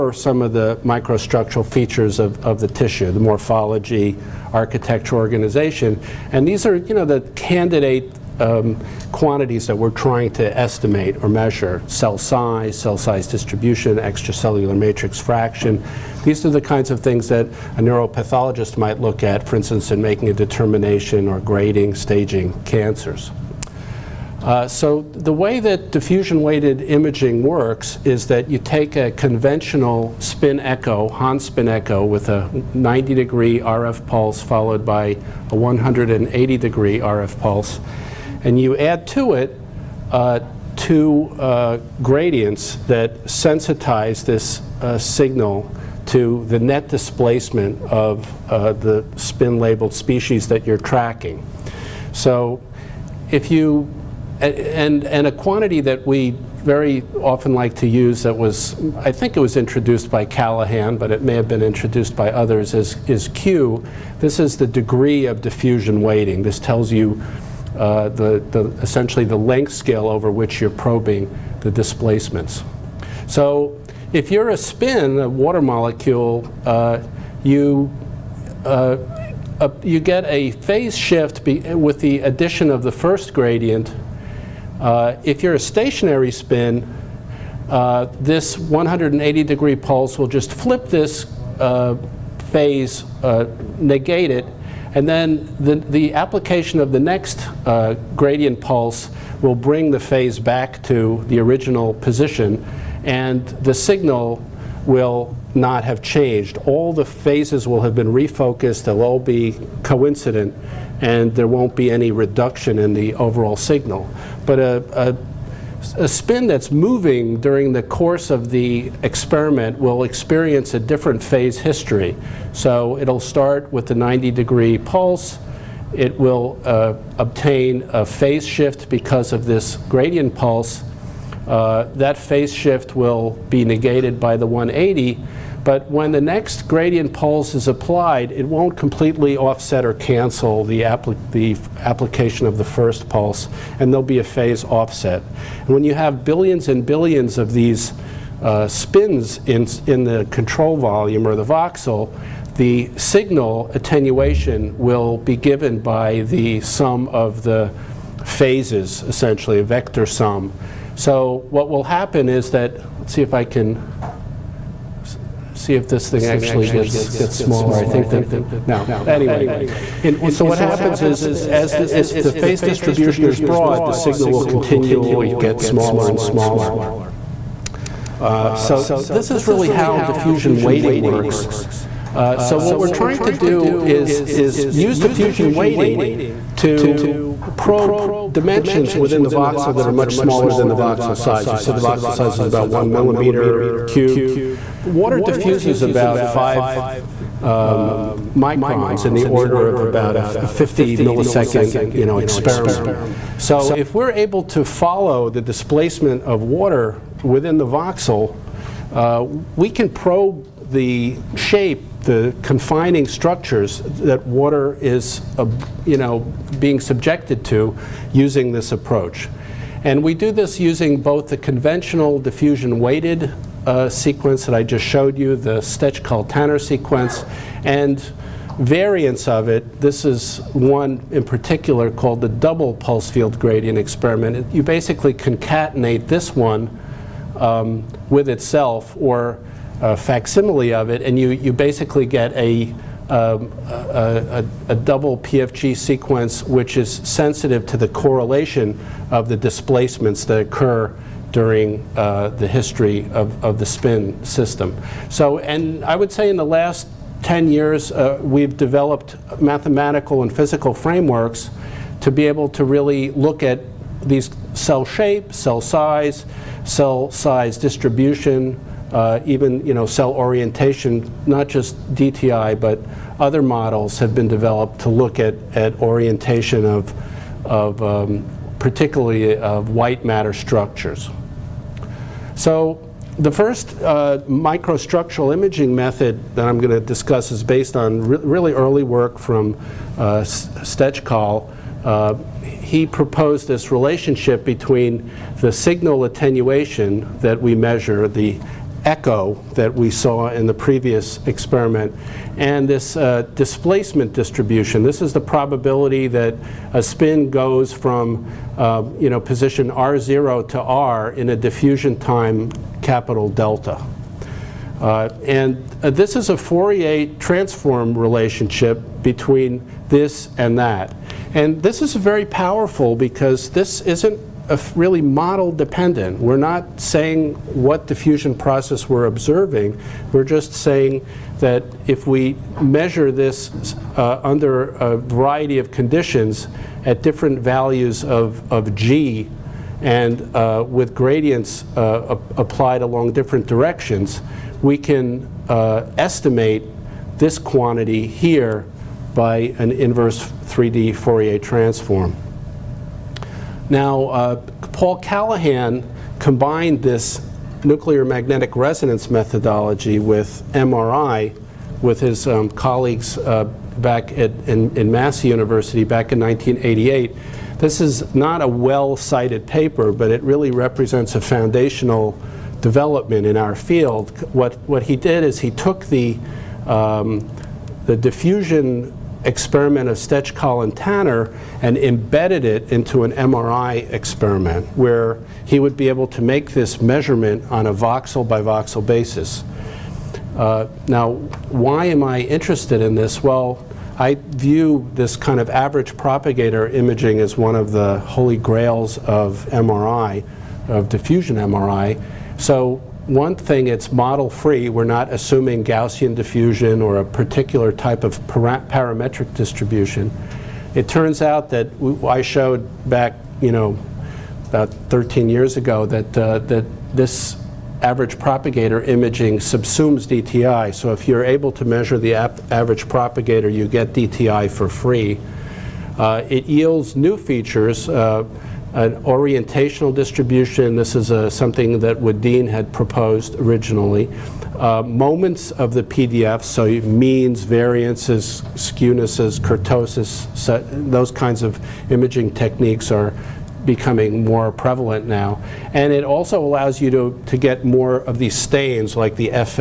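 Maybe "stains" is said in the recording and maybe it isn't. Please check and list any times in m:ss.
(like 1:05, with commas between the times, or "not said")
7:28.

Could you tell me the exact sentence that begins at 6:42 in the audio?
So one thing, it's model free.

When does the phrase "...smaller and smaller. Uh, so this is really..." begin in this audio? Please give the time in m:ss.
2:55.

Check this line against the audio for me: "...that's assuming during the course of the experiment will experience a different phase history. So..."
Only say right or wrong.
wrong.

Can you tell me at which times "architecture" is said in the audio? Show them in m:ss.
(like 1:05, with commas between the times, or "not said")
0:04.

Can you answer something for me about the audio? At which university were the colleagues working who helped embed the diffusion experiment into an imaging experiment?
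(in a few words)
Massey University.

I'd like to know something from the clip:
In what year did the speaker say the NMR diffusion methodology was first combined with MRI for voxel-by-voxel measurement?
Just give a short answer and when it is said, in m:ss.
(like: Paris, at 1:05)
1988, at 6:06.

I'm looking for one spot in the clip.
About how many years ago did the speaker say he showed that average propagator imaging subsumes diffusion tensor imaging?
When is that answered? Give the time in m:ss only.
6:54.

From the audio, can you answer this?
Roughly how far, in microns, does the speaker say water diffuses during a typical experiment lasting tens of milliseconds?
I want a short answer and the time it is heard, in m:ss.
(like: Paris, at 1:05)
5 microns, at 3:16.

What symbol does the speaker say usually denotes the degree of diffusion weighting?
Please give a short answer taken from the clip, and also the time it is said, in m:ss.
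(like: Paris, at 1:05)
Q, at 1:03.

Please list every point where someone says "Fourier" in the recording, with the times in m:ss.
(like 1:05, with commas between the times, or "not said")
5:16, 5:50.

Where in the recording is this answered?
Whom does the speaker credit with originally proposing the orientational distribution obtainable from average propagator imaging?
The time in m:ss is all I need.
7:11.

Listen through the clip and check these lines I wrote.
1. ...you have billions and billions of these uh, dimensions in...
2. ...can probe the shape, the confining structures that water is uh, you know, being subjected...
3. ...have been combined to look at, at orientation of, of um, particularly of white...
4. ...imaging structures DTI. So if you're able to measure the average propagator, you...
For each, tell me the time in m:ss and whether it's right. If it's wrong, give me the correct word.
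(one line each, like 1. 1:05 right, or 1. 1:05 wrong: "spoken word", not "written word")
1. 2:25 wrong: "spins", not "dimensions"
2. 3:29 right
3. 4:33 wrong: "developed", not "combined"
4. 6:58 wrong: "subsumes", not "structures".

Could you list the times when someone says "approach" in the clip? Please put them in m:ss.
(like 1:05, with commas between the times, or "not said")
3:38.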